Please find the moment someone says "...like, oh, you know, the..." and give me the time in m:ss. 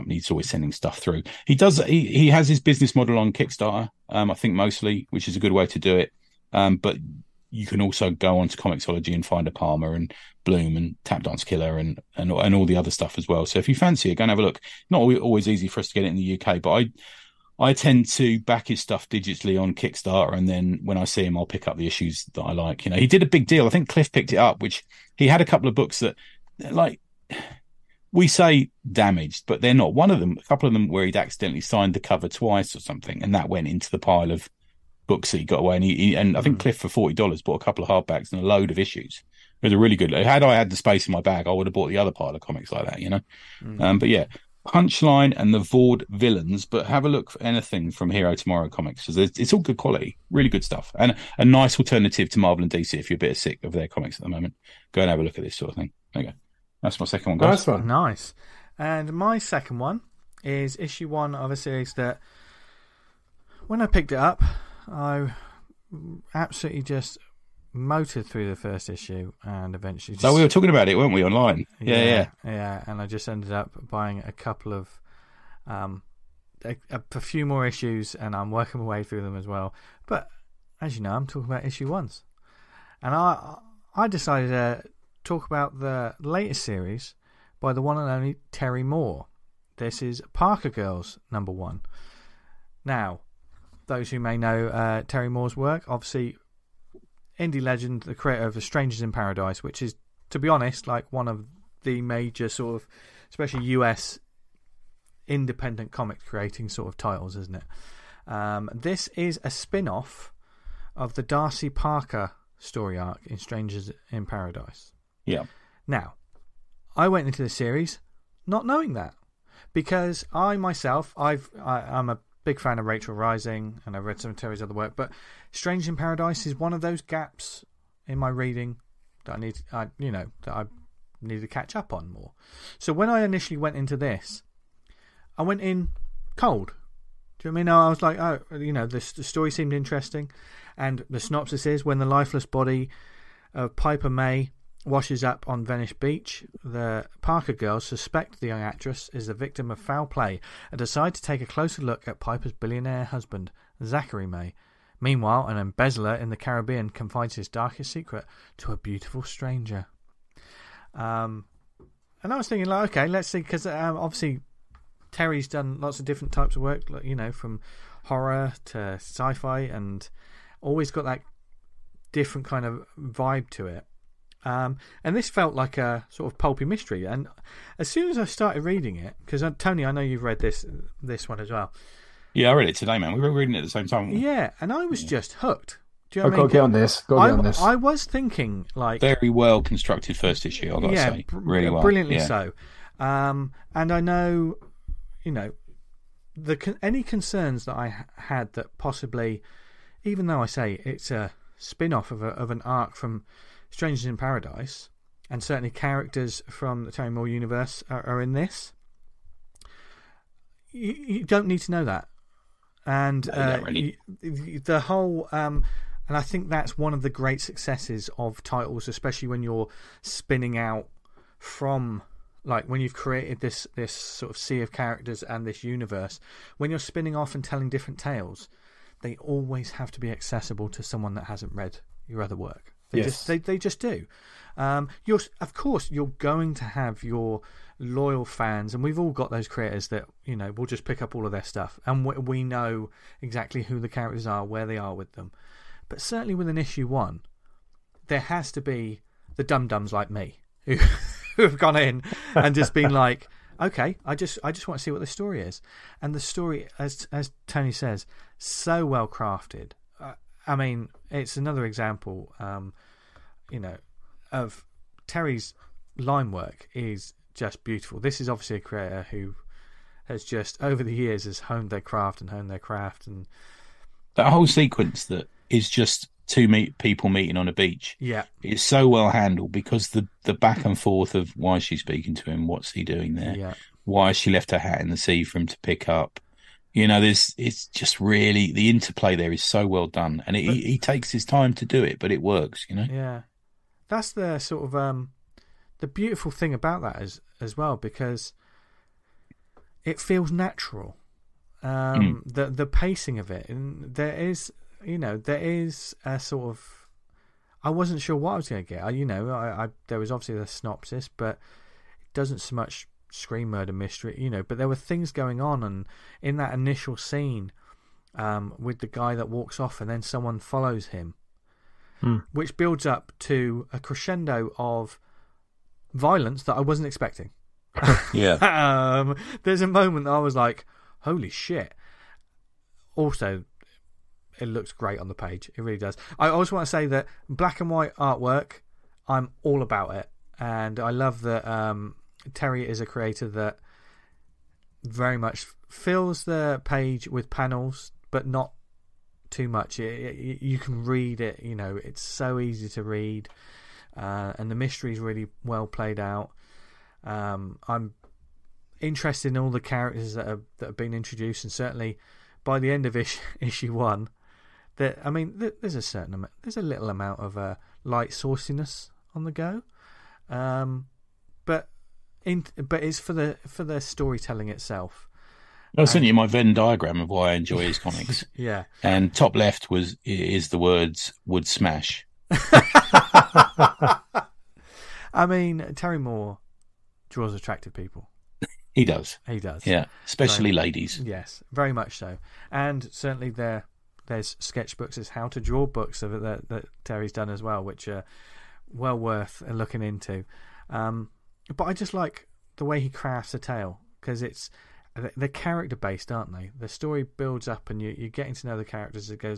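2:18.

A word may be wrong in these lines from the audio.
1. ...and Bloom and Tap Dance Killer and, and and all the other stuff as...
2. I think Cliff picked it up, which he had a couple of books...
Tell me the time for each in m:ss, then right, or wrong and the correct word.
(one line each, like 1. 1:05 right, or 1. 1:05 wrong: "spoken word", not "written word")
1. 0:09 right
2. 0:23 right.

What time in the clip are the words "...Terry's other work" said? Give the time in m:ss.
2:04.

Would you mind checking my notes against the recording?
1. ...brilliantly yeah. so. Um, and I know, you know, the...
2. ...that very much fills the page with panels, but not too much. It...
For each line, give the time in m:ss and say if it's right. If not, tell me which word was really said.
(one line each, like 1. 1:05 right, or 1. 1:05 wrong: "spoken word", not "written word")
1. 3:11 right
2. 5:43 right.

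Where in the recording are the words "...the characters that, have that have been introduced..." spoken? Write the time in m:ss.
5:59.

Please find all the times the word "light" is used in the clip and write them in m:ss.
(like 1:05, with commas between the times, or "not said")
6:07.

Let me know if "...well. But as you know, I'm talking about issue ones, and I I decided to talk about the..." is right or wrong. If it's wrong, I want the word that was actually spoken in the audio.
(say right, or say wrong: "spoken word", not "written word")
right.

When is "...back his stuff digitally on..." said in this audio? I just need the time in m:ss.
0:18.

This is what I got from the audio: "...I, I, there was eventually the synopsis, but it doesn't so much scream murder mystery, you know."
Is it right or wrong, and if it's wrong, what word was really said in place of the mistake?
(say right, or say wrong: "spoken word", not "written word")
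wrong: "obviously", not "eventually".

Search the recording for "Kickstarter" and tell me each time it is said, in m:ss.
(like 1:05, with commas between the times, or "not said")
0:03, 0:19.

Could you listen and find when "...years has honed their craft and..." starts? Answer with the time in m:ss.
4:30.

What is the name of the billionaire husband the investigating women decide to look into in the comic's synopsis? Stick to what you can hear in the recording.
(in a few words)
Zachary May.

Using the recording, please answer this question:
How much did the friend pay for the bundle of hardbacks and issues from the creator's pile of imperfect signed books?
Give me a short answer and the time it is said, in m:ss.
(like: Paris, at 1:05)
$40, at 0:36.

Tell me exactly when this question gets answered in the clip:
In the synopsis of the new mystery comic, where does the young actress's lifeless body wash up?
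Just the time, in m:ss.
2:25.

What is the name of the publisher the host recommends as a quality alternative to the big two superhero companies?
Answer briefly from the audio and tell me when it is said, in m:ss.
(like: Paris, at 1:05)
Hero Tomorrow Comics, at 0:48.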